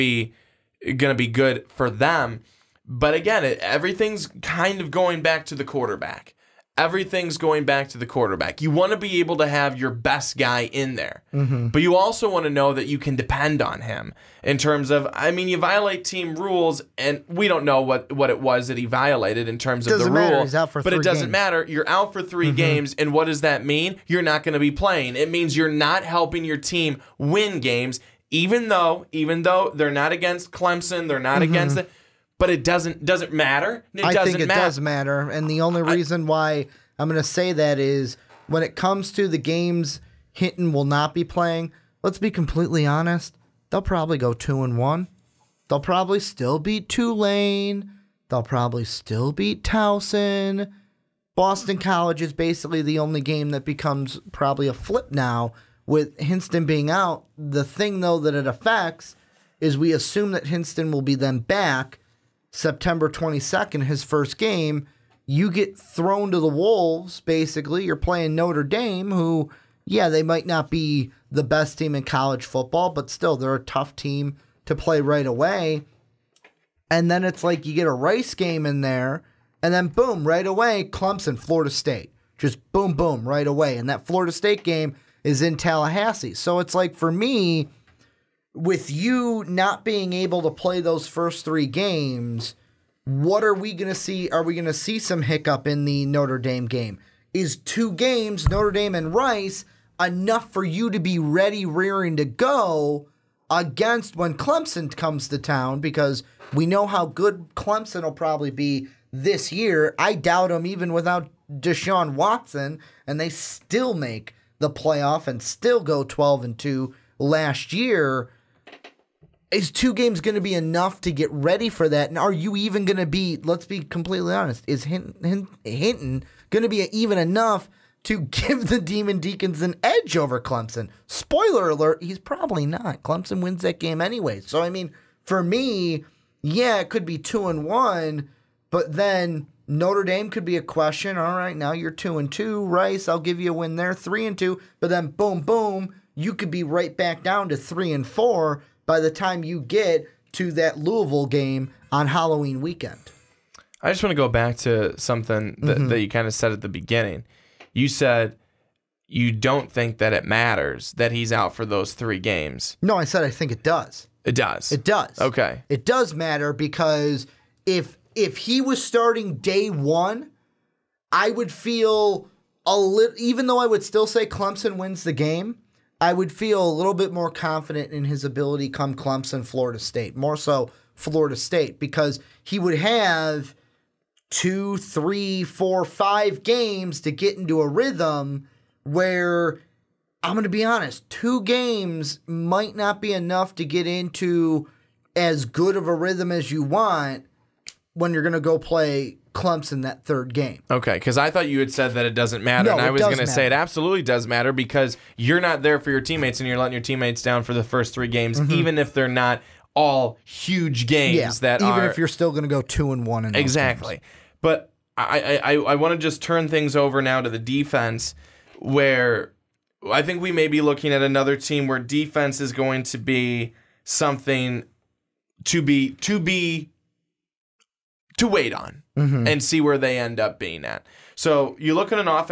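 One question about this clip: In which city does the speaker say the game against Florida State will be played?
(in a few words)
Tallahassee.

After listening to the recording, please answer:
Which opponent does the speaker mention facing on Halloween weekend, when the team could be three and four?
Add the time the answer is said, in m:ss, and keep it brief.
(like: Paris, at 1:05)
Louisville, at 2:30.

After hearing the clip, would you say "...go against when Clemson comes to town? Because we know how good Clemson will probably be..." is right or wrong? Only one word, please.
right.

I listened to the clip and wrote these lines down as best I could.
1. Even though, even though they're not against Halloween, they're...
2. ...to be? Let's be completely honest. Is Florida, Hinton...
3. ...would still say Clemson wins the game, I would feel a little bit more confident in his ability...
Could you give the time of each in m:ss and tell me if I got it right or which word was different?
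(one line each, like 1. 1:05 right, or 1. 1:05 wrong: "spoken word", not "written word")
1. 0:28 wrong: "Clemson", not "Halloween"
2. 2:02 wrong: "Hinton", not "Florida"
3. 2:53 right.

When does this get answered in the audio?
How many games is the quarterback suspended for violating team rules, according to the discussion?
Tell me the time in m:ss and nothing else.
0:22.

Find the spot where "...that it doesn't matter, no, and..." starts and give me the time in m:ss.
3:21.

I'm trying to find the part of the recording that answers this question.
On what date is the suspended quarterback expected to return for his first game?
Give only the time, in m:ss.
1:02.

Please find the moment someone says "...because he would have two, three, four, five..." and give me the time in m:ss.
3:01.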